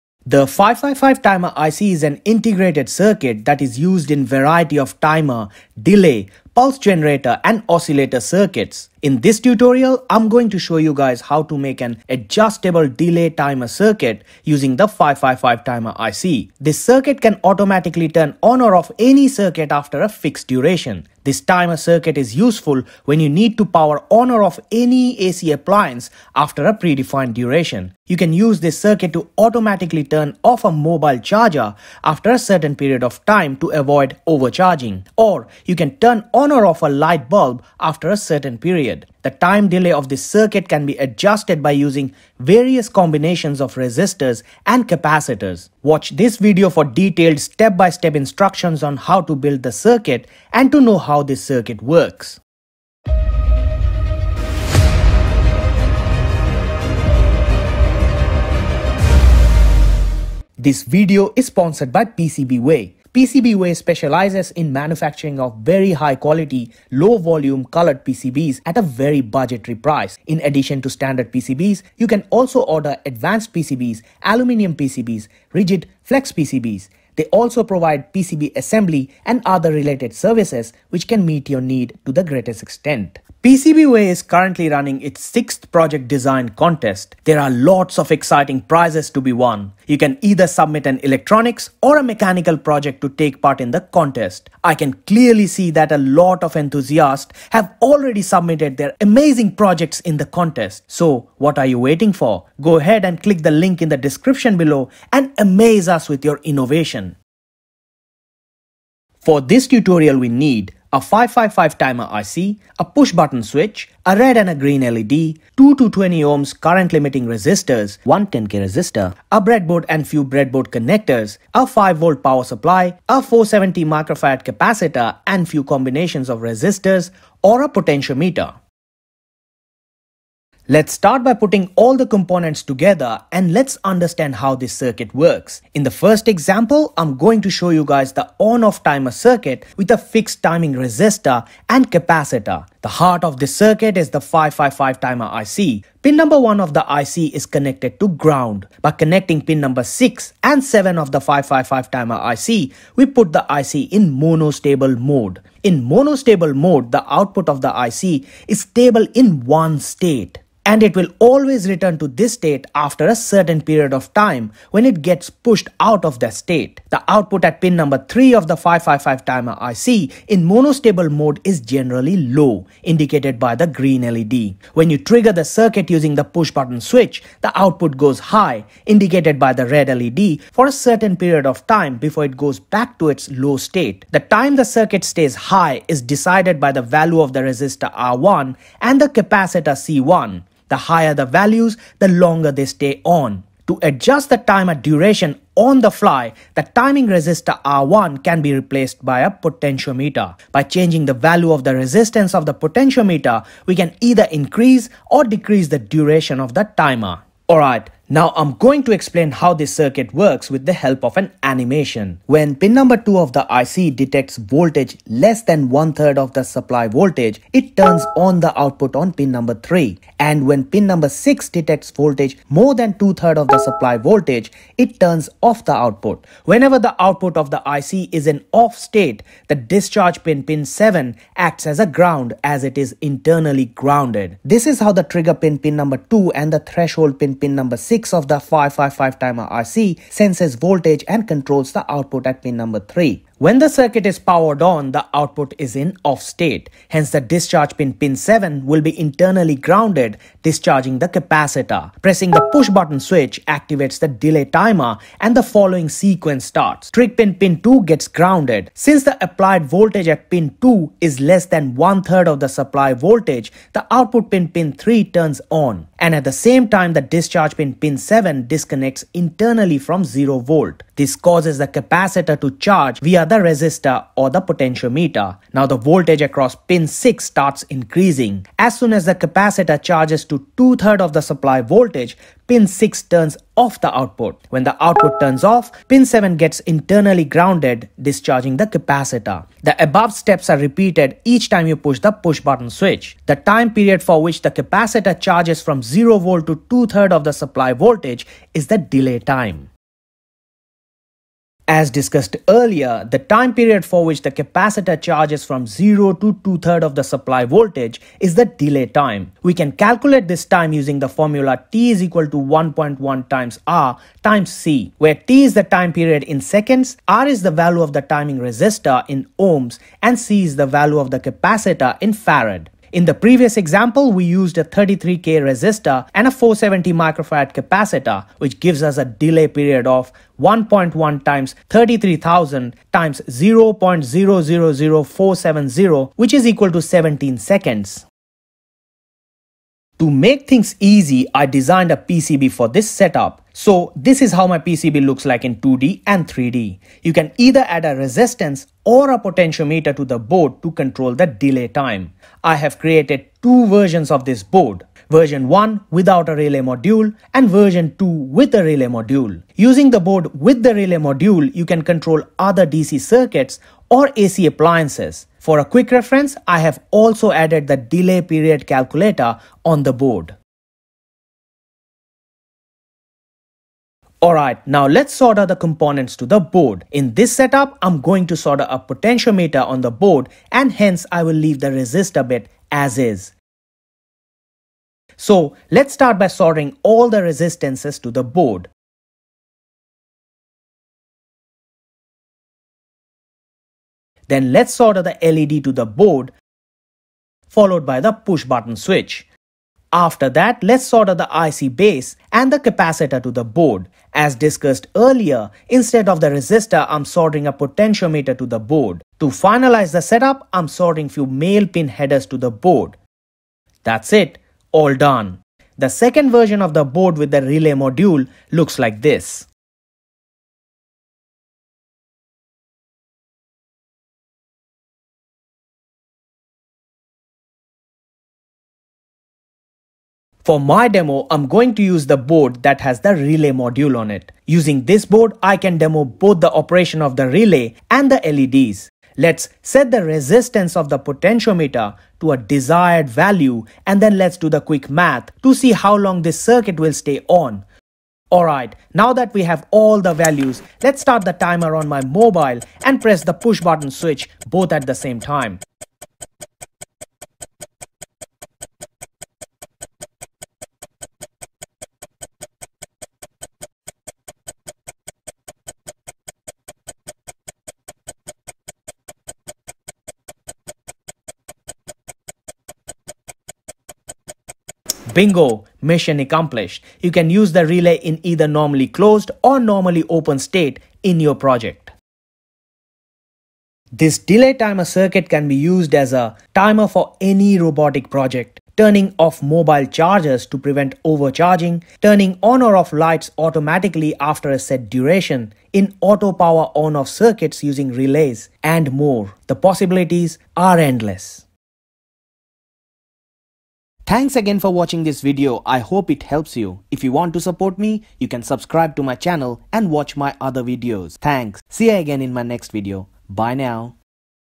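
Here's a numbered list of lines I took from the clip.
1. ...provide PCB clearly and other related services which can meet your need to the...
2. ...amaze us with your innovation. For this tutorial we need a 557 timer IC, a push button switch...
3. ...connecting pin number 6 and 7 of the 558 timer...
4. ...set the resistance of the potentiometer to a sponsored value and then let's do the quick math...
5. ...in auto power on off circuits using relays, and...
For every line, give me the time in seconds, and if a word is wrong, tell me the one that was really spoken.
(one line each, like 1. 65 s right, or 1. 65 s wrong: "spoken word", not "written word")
1. 77 s wrong: "assembly", not "clearly"
2. 105 s wrong: "555", not "557"
3. 148 s wrong: "555", not "558"
4. 439 s wrong: "desired", not "sponsored"
5. 495 s right.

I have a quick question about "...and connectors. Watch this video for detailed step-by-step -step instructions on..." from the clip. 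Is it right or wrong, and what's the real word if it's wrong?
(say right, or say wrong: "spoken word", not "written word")
wrong: "capacitors", not "connectors".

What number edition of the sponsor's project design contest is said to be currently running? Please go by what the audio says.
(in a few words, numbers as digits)
sixth.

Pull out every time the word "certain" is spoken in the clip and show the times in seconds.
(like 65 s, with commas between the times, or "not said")
32 s, 38 s, 163 s, 180 s.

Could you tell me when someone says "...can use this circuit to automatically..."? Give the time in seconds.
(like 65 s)
28 s.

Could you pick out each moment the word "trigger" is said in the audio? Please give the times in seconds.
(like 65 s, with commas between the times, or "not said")
174 s, 235 s, 256 s.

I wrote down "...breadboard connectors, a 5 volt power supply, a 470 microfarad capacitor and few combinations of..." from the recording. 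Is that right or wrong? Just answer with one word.
right.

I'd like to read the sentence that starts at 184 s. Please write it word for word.
The time the circuit stays high is decided by the value of the resistor R1 and the capacitor C1.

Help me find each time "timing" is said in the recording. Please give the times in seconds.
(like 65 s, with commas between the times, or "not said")
140 s, 196 s, 318 s.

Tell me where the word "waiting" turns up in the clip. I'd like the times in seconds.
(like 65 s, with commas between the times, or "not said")
101 s.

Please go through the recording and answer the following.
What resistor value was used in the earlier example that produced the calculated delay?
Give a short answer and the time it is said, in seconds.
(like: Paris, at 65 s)
33K, at 324 s.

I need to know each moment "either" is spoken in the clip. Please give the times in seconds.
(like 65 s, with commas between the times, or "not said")
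90 s, 203 s, 347 s, 478 s.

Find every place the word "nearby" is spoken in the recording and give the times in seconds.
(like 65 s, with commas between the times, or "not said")
not said.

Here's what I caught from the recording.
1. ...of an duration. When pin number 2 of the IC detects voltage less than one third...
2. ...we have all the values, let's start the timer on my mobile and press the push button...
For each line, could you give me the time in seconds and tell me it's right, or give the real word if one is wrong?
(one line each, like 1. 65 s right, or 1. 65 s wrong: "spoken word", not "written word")
1. 211 s wrong: "animation", not "duration"
2. 449 s right.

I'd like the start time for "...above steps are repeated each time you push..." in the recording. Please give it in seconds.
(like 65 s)
289 s.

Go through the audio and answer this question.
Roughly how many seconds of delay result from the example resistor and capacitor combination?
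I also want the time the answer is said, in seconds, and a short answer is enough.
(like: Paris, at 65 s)
17 seconds, at 336 s.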